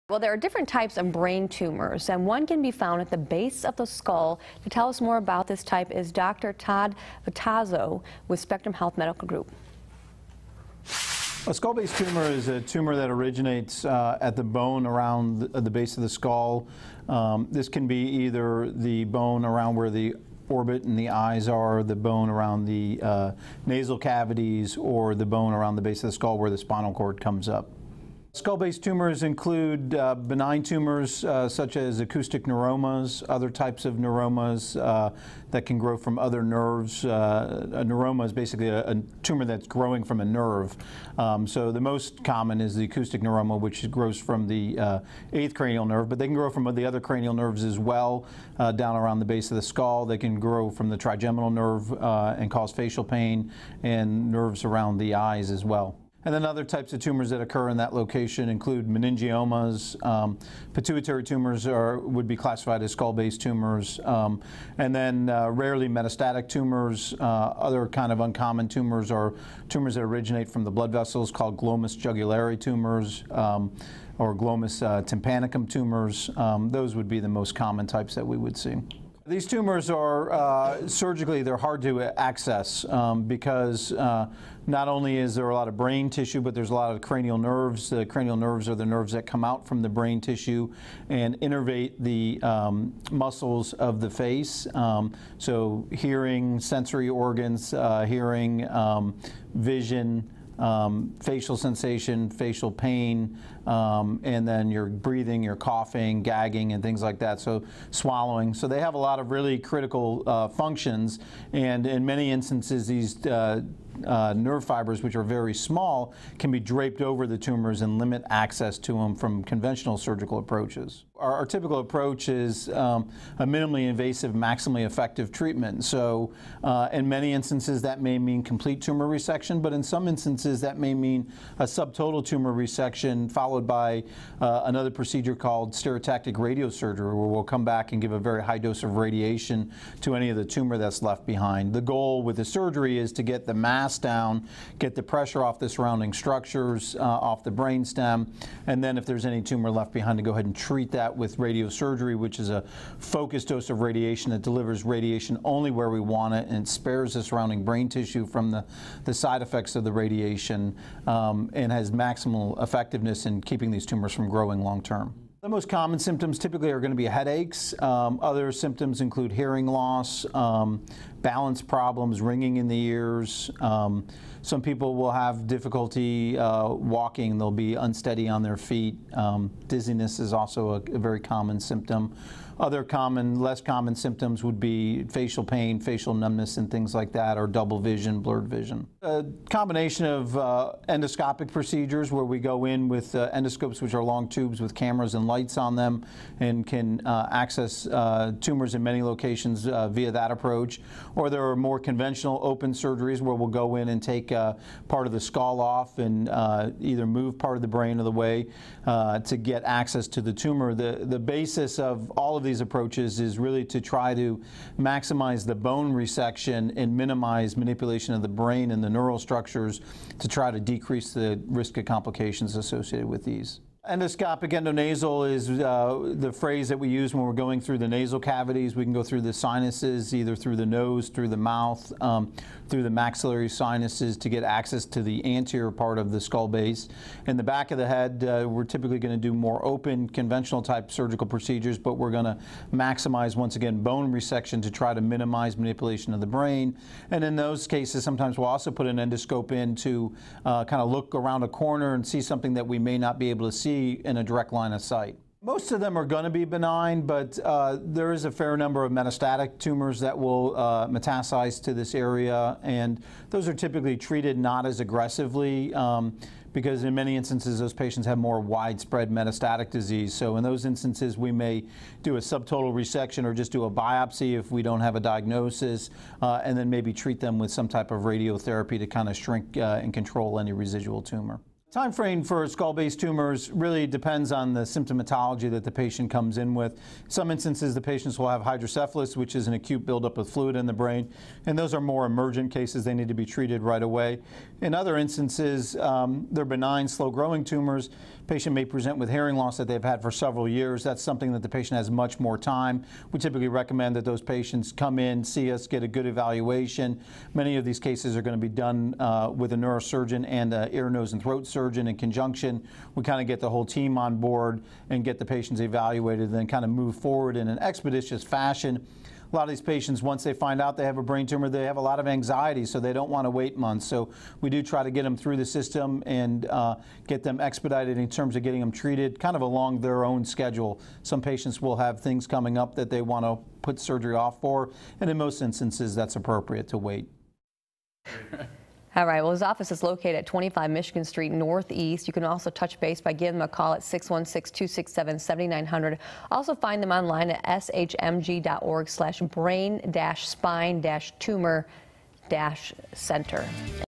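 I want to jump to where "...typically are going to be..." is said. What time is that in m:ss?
2:46.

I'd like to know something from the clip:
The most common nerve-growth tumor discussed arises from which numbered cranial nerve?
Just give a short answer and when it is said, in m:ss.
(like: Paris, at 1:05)
8th, at 0:45.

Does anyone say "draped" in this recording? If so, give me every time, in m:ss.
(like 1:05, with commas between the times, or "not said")
1:56.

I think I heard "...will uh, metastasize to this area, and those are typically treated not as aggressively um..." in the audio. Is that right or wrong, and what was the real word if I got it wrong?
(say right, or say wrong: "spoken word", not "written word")
right.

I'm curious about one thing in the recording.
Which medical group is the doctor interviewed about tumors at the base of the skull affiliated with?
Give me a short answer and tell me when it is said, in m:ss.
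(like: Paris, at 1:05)
Spectrum Health Medical Group, at 0:08.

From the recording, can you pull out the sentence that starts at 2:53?
Um, some people will have difficulty uh, walking.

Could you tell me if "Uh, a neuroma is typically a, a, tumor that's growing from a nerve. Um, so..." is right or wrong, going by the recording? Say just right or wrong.
wrong.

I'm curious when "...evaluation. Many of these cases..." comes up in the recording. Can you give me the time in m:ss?
5:06.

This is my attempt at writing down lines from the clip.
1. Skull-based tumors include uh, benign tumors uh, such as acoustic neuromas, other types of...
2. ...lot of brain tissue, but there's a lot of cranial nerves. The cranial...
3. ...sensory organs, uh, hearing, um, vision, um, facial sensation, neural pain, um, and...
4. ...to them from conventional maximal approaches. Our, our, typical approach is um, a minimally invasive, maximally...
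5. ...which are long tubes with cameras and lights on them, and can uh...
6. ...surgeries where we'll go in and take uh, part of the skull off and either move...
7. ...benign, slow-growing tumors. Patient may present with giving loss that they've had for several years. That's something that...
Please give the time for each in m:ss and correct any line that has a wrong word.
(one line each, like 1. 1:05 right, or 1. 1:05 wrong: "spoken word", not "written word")
1. 0:28 right
2. 1:25 right
3. 1:36 wrong: "facial", not "neural"
4. 1:58 wrong: "surgical", not "maximal"
5. 3:13 right
6. 3:22 right
7. 4:56 wrong: "hearing", not "giving".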